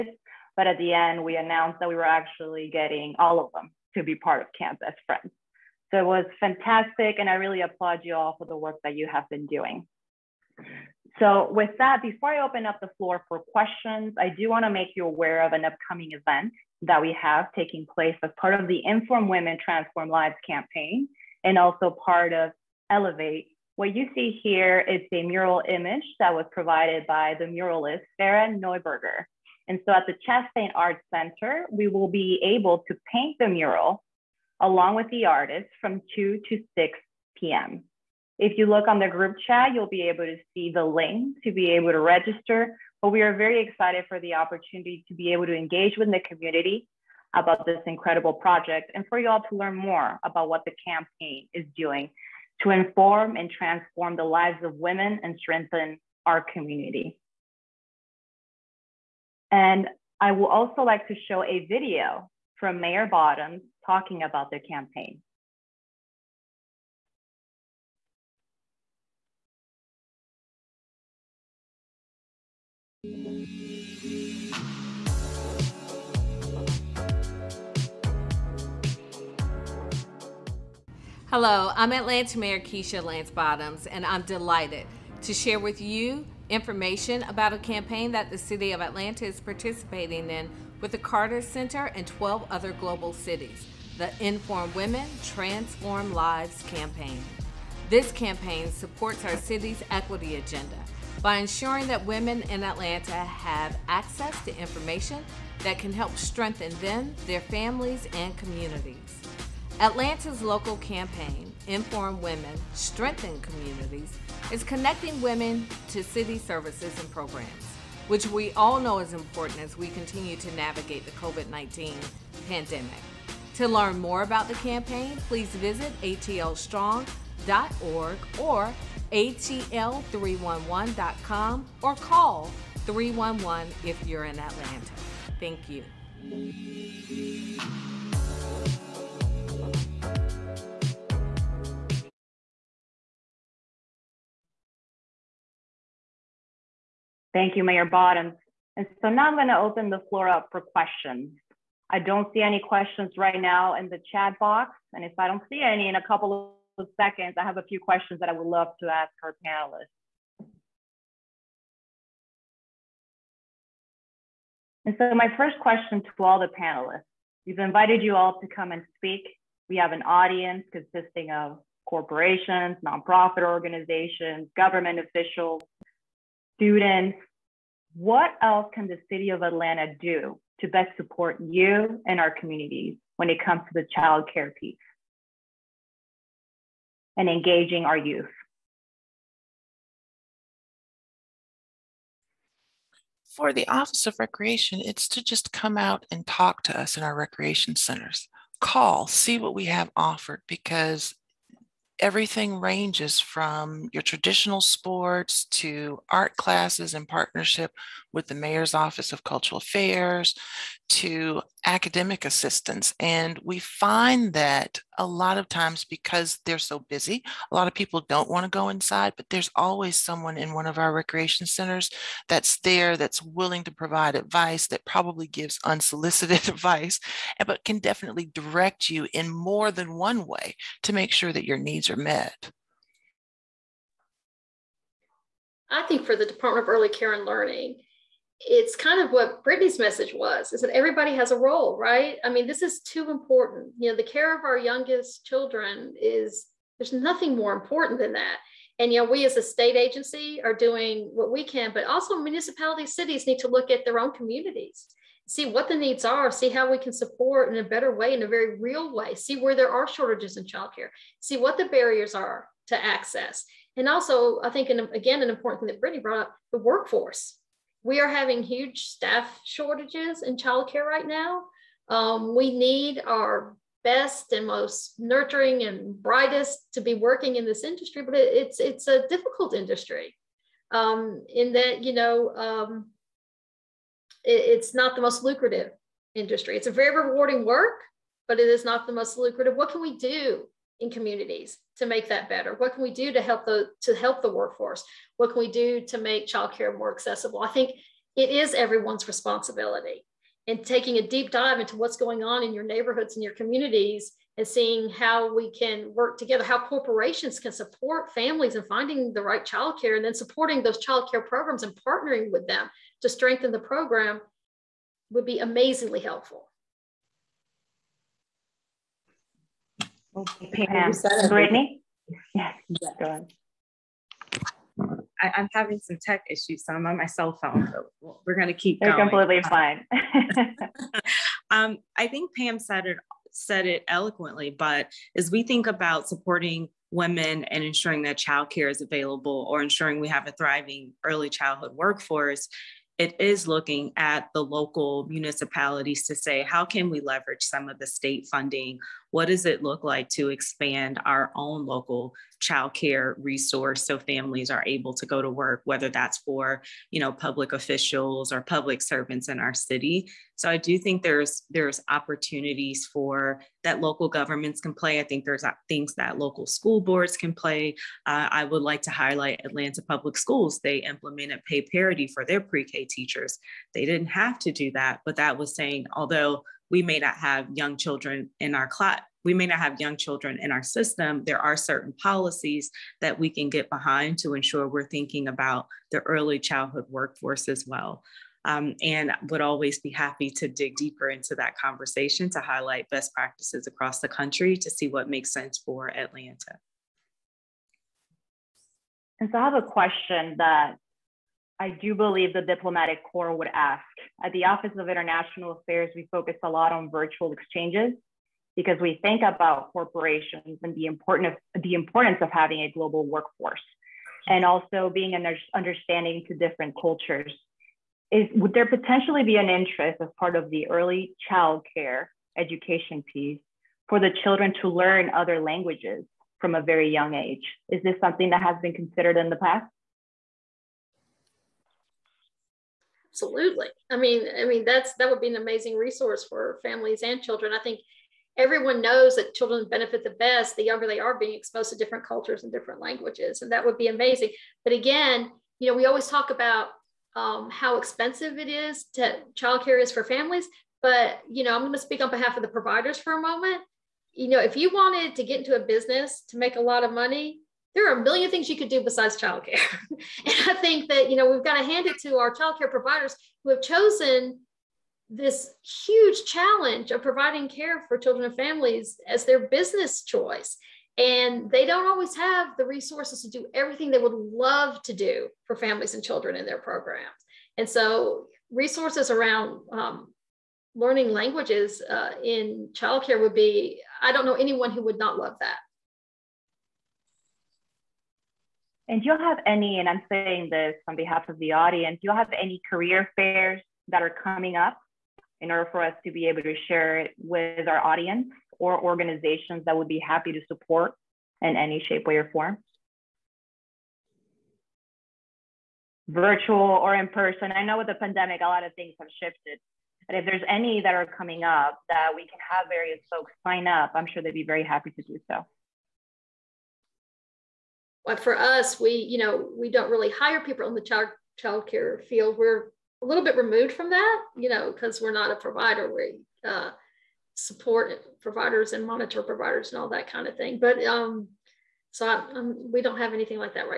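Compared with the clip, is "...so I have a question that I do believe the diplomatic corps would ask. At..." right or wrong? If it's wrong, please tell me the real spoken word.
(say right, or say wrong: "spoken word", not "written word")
right.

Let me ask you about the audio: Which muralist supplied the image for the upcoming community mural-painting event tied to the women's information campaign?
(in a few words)
Sarah Neuberger.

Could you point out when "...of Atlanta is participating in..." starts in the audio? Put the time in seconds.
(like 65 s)
88 s.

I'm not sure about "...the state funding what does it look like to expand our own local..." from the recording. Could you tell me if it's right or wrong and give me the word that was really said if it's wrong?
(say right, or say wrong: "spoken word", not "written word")
right.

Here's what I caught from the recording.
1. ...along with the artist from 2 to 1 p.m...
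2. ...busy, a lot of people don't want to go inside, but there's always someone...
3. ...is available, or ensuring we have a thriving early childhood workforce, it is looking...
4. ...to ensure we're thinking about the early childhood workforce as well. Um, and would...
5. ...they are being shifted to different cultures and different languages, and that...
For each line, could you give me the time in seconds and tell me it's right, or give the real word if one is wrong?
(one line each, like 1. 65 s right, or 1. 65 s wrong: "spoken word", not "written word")
1. 34 s wrong: "6", not "1"
2. 216 s right
3. 338 s right
4. 384 s right
5. 440 s wrong: "exposed", not "shifted".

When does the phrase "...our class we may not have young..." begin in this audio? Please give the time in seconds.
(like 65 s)
378 s.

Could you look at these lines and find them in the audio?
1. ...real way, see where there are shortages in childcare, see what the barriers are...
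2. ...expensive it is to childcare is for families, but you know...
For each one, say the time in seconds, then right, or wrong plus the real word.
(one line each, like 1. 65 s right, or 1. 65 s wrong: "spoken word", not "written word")
1. 258 s right
2. 447 s right.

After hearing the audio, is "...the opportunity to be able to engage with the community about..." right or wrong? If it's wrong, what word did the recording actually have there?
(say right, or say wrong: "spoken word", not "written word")
right.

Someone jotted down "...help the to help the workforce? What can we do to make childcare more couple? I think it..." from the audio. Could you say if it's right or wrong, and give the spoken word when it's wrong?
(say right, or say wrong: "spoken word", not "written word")
wrong: "accessible", not "couple".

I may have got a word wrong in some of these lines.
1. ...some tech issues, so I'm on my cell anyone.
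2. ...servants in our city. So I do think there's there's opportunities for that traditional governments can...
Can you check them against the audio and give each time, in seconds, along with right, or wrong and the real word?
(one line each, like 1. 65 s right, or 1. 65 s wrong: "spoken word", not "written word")
1. 325 s wrong: "phone", not "anyone"
2. 358 s wrong: "local", not "traditional".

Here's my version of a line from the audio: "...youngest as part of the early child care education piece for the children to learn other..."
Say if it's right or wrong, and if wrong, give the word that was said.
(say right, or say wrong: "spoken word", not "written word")
wrong: "interest", not "youngest".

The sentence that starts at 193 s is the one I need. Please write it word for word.
For the Office of Recreation, it's to just come out and talk to us in our recreation centers.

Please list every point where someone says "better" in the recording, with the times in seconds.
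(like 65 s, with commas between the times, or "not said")
257 s, 292 s.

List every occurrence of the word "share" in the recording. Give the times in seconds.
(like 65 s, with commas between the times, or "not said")
85 s, 496 s.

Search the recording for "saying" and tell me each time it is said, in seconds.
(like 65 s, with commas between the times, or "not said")
375 s, 490 s.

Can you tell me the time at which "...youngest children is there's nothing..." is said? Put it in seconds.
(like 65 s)
244 s.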